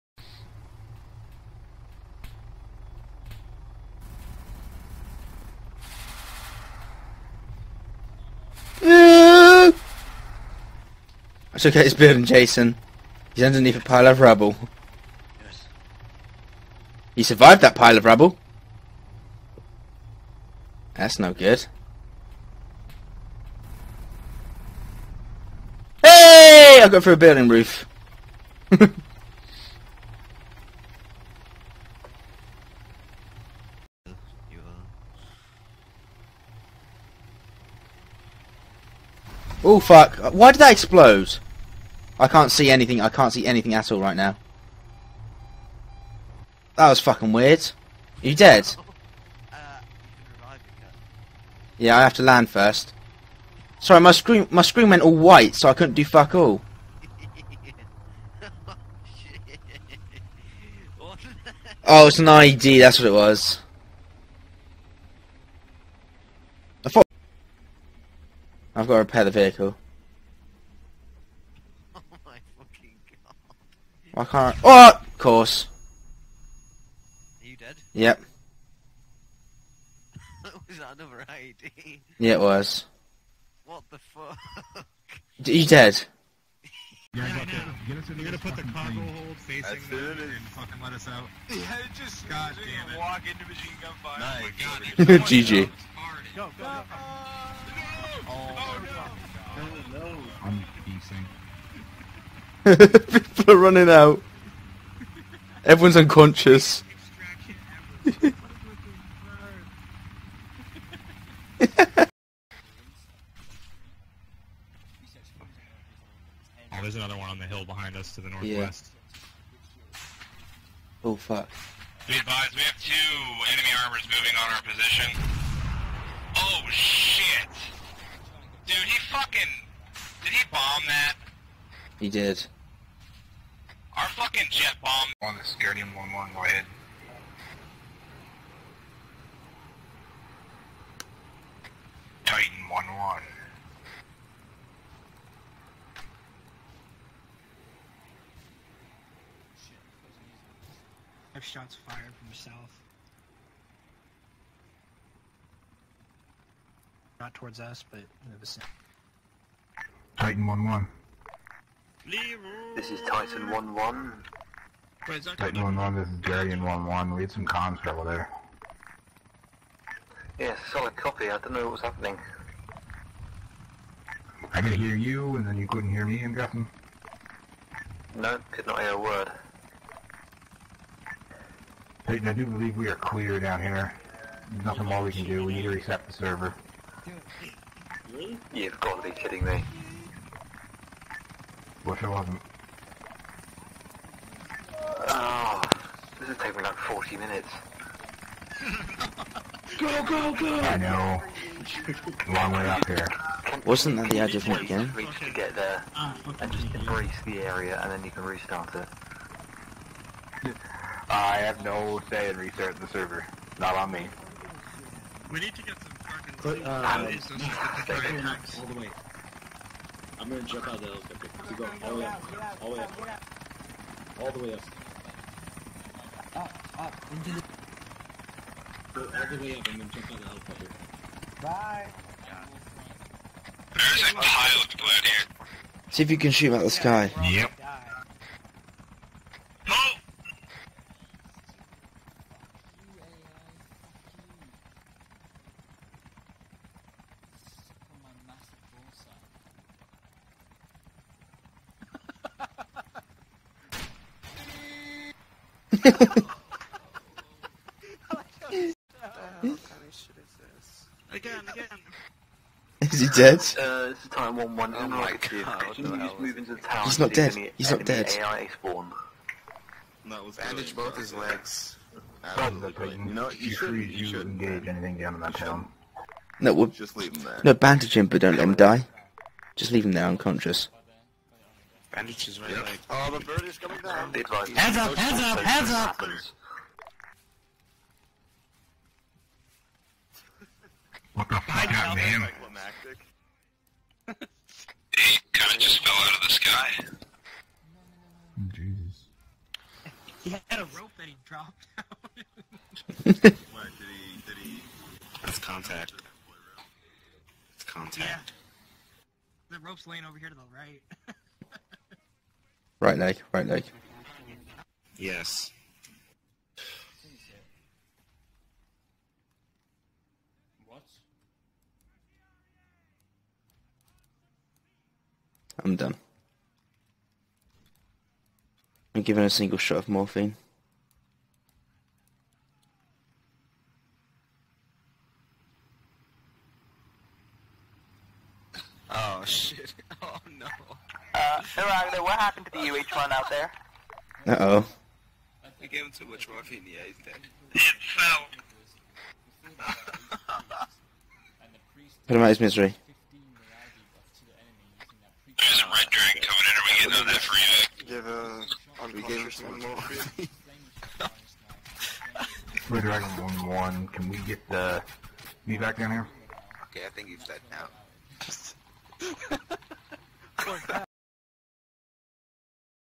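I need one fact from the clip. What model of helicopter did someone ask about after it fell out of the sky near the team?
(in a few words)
UH-1.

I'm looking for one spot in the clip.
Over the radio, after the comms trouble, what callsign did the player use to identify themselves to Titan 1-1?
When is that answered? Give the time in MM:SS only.
02:46.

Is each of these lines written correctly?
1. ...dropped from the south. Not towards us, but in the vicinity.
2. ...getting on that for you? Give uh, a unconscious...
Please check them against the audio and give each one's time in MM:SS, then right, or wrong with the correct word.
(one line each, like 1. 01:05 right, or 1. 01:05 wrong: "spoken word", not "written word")
1. 02:31 wrong: "fired", not "dropped"
2. 05:57 right.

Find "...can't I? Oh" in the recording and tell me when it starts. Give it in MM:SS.
01:14.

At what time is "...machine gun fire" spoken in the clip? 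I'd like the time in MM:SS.
01:33.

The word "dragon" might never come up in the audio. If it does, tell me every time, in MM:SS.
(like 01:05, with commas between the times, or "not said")
05:55, 06:02.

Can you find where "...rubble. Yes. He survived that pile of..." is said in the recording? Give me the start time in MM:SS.
00:14.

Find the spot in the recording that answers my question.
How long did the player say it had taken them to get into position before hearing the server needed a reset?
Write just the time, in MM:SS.
03:16.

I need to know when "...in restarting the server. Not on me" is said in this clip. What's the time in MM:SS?
03:32.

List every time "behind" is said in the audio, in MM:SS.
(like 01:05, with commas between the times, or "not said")
01:57.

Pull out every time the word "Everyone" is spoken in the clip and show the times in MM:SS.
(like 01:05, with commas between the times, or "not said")
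01:45.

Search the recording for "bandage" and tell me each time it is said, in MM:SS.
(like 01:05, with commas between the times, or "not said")
04:30, 04:37, 04:41.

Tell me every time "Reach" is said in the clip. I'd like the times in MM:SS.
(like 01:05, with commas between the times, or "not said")
03:24.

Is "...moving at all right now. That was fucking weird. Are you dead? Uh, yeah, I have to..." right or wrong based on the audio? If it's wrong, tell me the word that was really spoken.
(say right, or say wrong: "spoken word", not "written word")
wrong: "anything", not "moving".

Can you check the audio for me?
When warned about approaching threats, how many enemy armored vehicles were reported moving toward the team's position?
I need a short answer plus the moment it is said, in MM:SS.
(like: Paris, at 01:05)
2, at 02:02.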